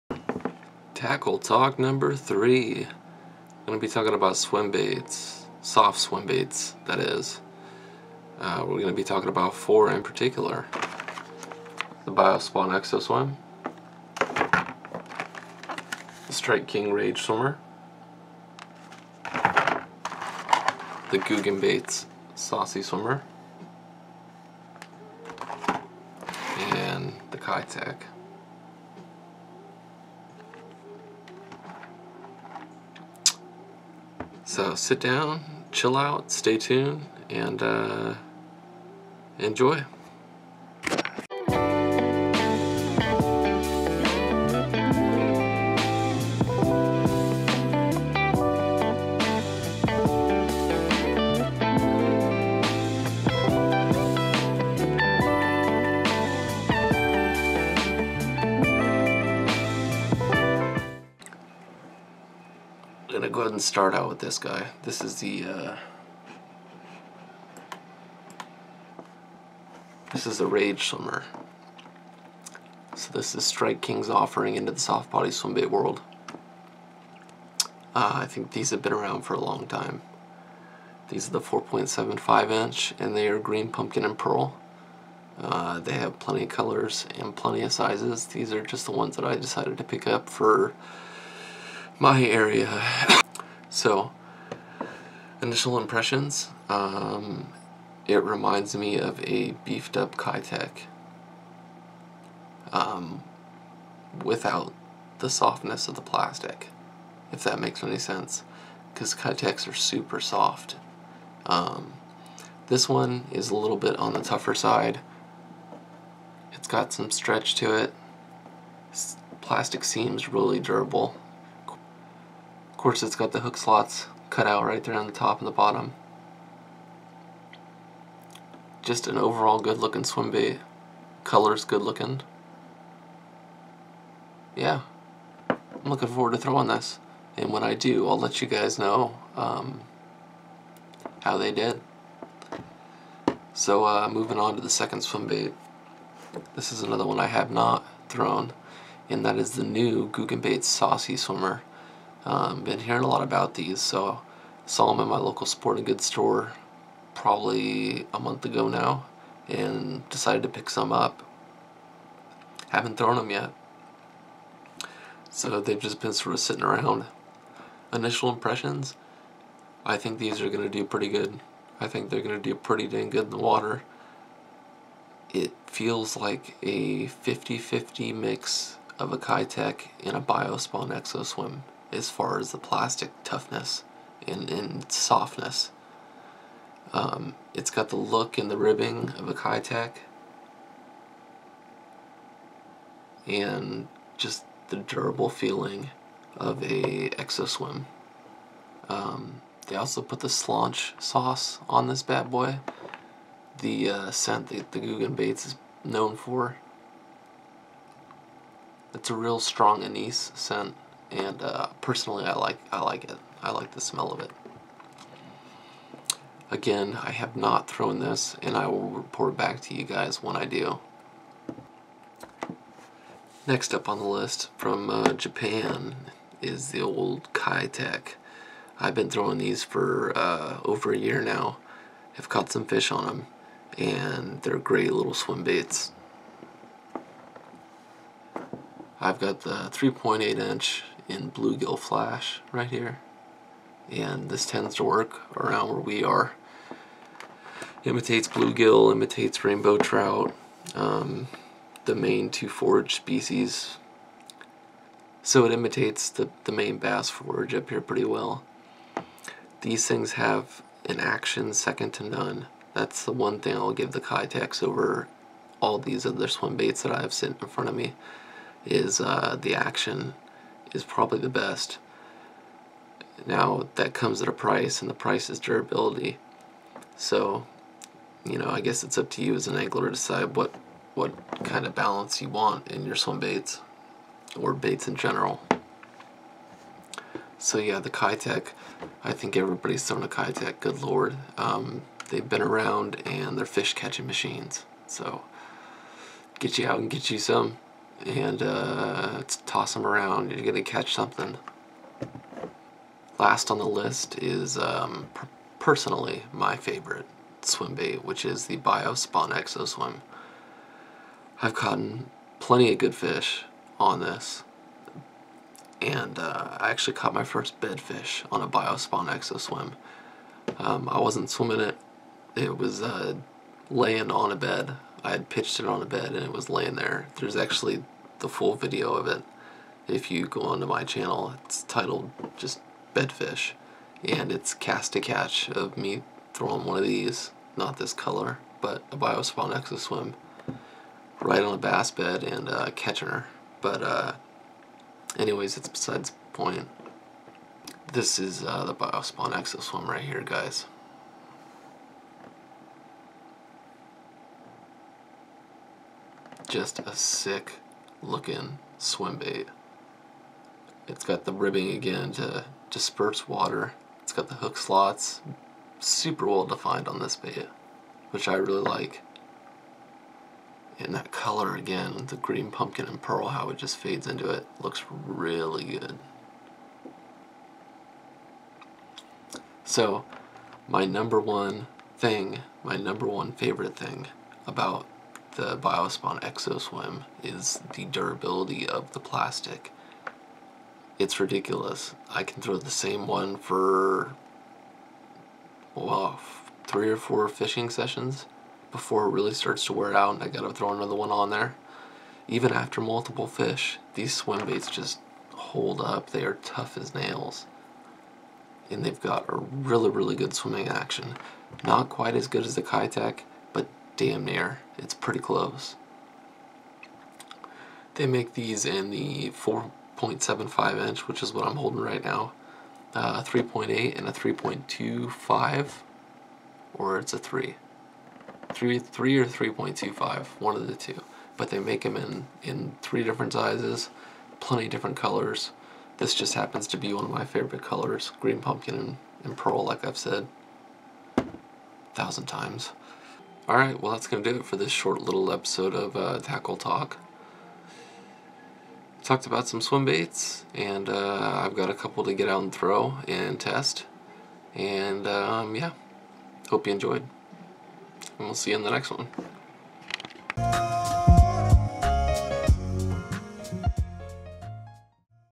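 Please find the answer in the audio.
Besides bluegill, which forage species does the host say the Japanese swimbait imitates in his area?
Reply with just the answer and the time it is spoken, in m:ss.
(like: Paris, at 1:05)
Rainbow trout, at 4:09.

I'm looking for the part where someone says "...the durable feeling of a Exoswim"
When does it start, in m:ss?
3:14.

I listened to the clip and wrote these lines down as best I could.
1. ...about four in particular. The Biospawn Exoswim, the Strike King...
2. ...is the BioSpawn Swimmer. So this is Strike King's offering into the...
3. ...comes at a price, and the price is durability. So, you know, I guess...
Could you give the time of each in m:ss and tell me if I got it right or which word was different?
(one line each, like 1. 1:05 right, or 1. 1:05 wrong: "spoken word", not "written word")
1. 0:09 right
2. 1:10 wrong: "Rage", not "BioSpawn"
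3. 4:33 right.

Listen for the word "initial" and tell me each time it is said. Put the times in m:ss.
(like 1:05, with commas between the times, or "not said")
1:35, 2:47.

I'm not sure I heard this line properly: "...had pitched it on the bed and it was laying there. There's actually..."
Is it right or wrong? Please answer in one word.
right.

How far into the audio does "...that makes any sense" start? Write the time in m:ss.
1:47.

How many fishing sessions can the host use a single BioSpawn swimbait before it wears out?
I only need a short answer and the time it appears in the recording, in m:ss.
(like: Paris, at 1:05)
3 or 4, at 6:36.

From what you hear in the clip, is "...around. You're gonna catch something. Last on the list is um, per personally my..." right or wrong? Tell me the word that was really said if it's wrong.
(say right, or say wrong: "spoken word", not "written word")
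right.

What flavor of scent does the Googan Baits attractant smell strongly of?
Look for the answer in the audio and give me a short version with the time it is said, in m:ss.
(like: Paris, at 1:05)
Anise, at 3:29.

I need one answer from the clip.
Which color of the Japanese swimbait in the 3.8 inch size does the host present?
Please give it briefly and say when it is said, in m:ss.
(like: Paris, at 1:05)
Bluegill flash, at 4:01.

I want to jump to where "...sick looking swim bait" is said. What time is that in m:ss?
5:56.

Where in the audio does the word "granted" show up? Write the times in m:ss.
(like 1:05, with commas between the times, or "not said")
not said.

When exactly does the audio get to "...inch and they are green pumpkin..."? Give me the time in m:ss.
1:22.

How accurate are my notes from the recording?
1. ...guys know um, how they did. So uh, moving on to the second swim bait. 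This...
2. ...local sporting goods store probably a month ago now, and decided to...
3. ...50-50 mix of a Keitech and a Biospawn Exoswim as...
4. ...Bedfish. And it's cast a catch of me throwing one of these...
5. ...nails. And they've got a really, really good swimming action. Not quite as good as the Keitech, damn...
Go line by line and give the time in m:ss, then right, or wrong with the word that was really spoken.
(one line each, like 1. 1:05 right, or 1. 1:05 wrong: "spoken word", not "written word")
1. 2:18 right
2. 2:35 right
3. 2:57 right
4. 5:32 right
5. 6:46 right.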